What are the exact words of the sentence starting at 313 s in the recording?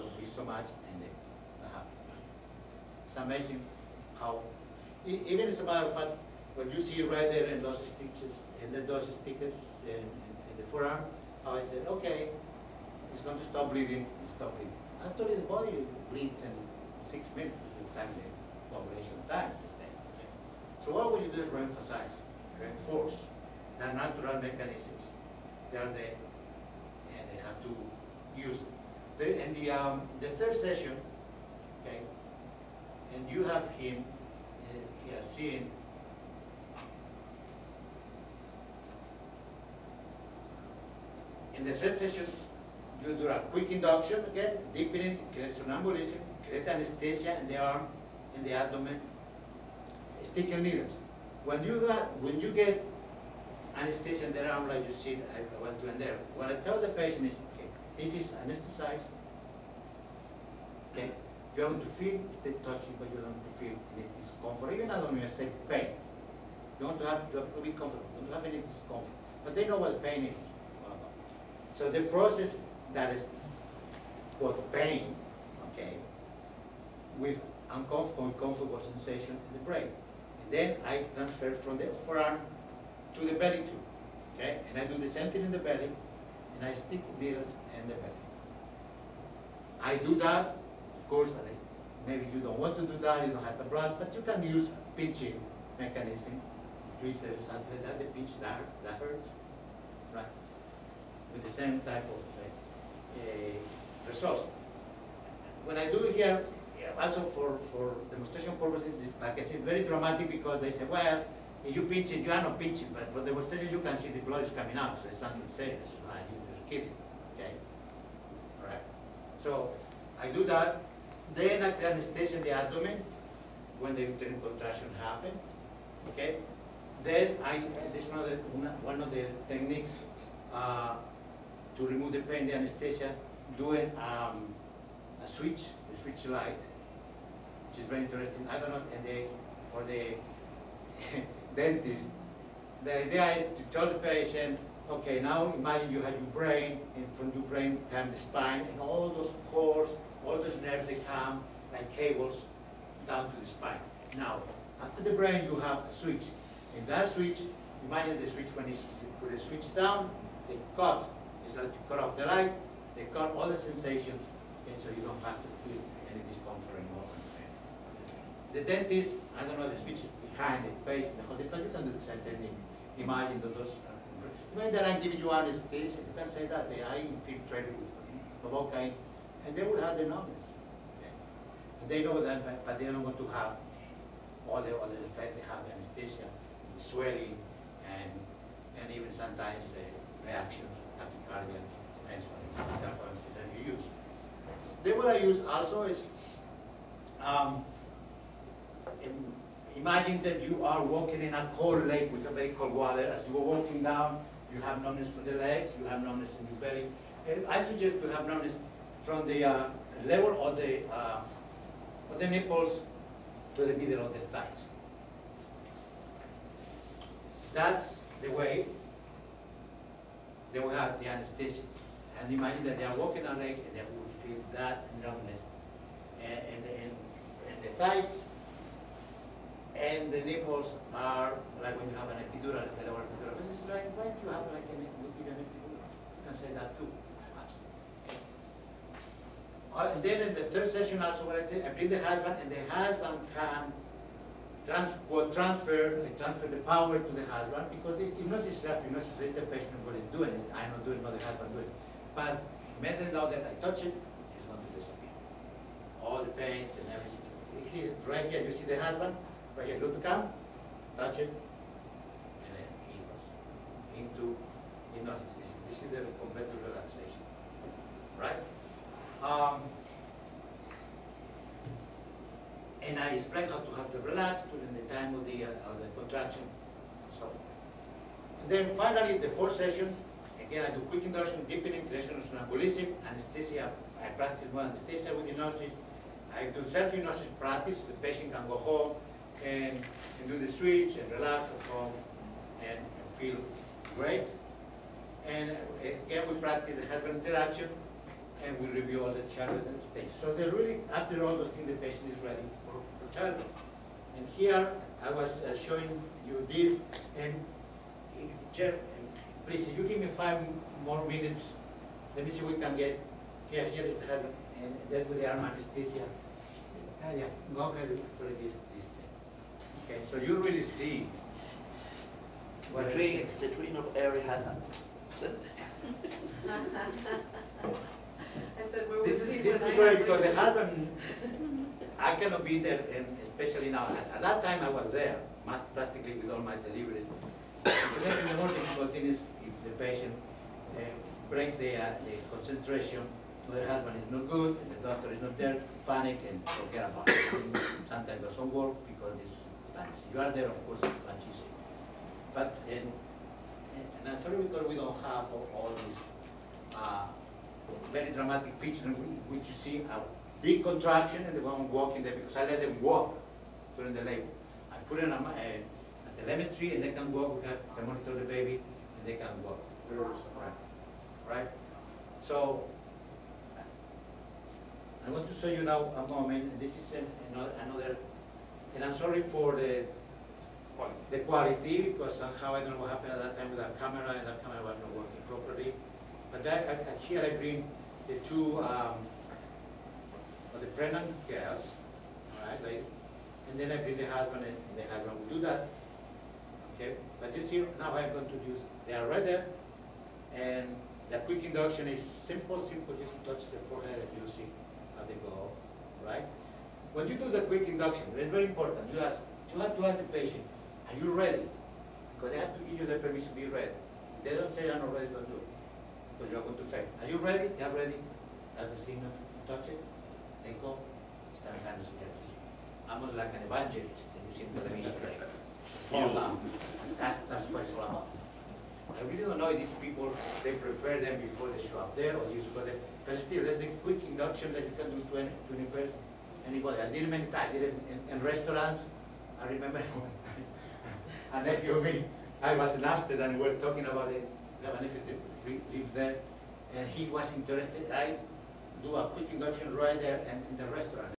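Here, here is the head, and that's with the arm anesthesia.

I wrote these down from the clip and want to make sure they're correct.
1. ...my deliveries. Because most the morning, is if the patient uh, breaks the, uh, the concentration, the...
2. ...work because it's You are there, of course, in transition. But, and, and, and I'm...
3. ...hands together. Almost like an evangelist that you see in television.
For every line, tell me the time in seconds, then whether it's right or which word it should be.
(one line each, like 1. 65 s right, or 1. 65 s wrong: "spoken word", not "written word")
1. 336 s right
2. 348 s right
3. 421 s right.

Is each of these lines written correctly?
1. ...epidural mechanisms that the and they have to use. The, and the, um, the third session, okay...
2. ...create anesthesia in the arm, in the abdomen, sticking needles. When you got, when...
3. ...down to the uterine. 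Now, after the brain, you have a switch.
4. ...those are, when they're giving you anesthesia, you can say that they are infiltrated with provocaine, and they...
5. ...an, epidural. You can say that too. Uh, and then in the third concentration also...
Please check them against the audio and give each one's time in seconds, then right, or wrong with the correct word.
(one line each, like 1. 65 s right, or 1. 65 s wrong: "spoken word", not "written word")
1. 23 s wrong: "natural", not "epidural"
2. 46 s right
3. 153 s wrong: "spine", not "uterine"
4. 173 s right
5. 234 s wrong: "session", not "concentration".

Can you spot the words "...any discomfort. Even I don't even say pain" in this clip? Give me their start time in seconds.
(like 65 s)
63 s.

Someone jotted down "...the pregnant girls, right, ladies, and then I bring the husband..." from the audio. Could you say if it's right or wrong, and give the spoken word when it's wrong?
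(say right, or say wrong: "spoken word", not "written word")
right.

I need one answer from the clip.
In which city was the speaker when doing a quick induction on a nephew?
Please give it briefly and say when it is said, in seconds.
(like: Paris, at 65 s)
Amsterdam, at 442 s.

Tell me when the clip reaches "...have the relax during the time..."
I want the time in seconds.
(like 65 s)
273 s.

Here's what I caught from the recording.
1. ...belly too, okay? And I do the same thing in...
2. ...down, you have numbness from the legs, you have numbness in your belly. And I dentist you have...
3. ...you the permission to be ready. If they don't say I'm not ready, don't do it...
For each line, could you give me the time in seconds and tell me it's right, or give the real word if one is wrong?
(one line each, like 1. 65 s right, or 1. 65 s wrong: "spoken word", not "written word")
1. 83 s right
2. 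203 s wrong: "suggest", not "dentist"
3. 412 s right.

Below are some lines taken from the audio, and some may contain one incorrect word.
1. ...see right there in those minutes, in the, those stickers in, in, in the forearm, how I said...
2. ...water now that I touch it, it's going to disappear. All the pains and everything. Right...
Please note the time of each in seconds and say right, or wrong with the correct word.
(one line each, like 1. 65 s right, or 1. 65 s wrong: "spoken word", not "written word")
1. 6 s wrong: "stitches", not "minutes"
2. 252 s wrong: "matter", not "water".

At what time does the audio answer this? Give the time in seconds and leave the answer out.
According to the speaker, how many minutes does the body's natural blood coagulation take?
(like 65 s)
17 s.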